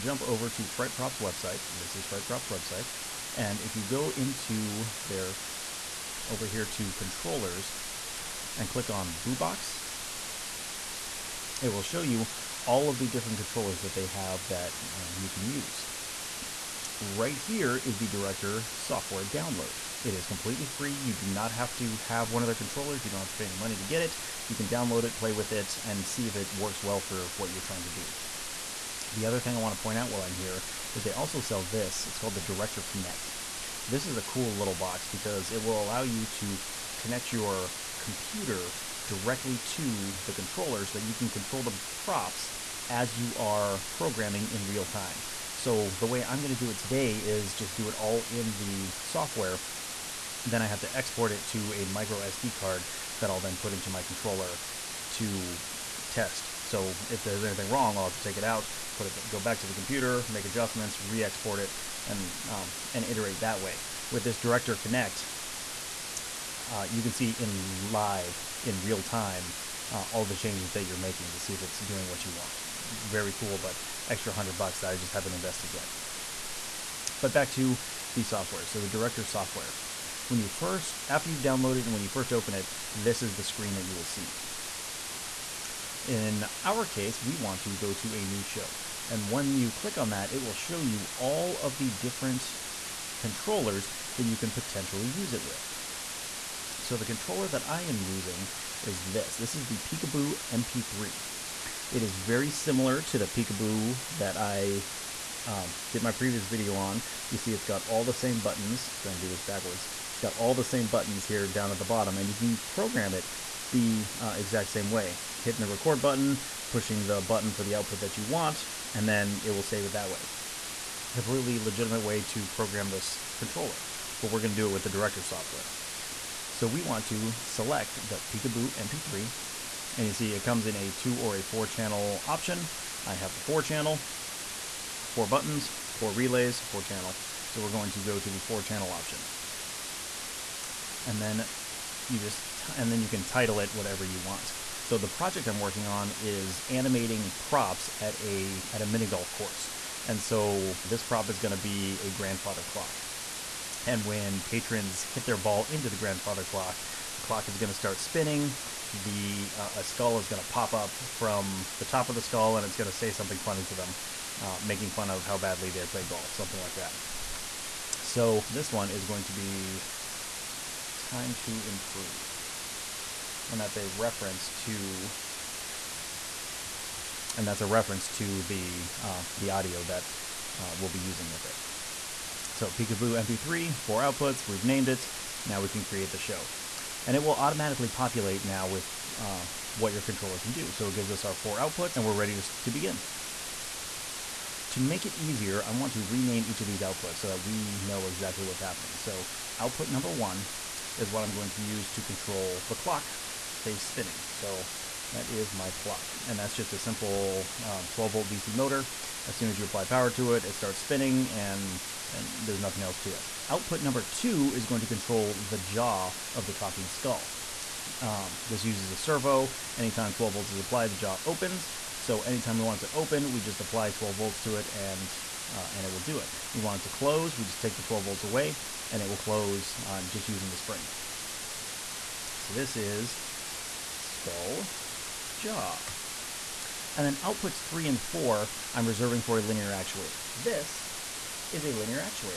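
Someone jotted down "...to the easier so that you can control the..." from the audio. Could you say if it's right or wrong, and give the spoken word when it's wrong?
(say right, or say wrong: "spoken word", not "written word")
wrong: "controller", not "easier".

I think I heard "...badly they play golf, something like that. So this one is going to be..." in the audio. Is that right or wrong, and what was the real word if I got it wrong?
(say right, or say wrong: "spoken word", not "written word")
right.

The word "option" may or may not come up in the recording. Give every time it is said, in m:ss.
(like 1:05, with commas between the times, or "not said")
2:12, 2:18.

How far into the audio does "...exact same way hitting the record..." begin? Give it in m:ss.
1:54.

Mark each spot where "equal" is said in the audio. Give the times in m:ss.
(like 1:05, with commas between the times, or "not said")
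not said.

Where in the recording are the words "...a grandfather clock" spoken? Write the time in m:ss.
2:32.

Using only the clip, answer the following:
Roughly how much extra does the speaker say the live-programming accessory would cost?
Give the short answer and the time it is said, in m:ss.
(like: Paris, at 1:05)
$100, at 1:14.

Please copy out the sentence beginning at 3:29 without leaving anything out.
As soon as you apply power to it, it starts spinning and and there's nothing else to it.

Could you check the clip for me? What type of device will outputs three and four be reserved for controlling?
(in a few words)
linear actuator.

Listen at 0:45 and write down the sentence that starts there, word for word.
So the way I'm going to do it today is just do it all in the software.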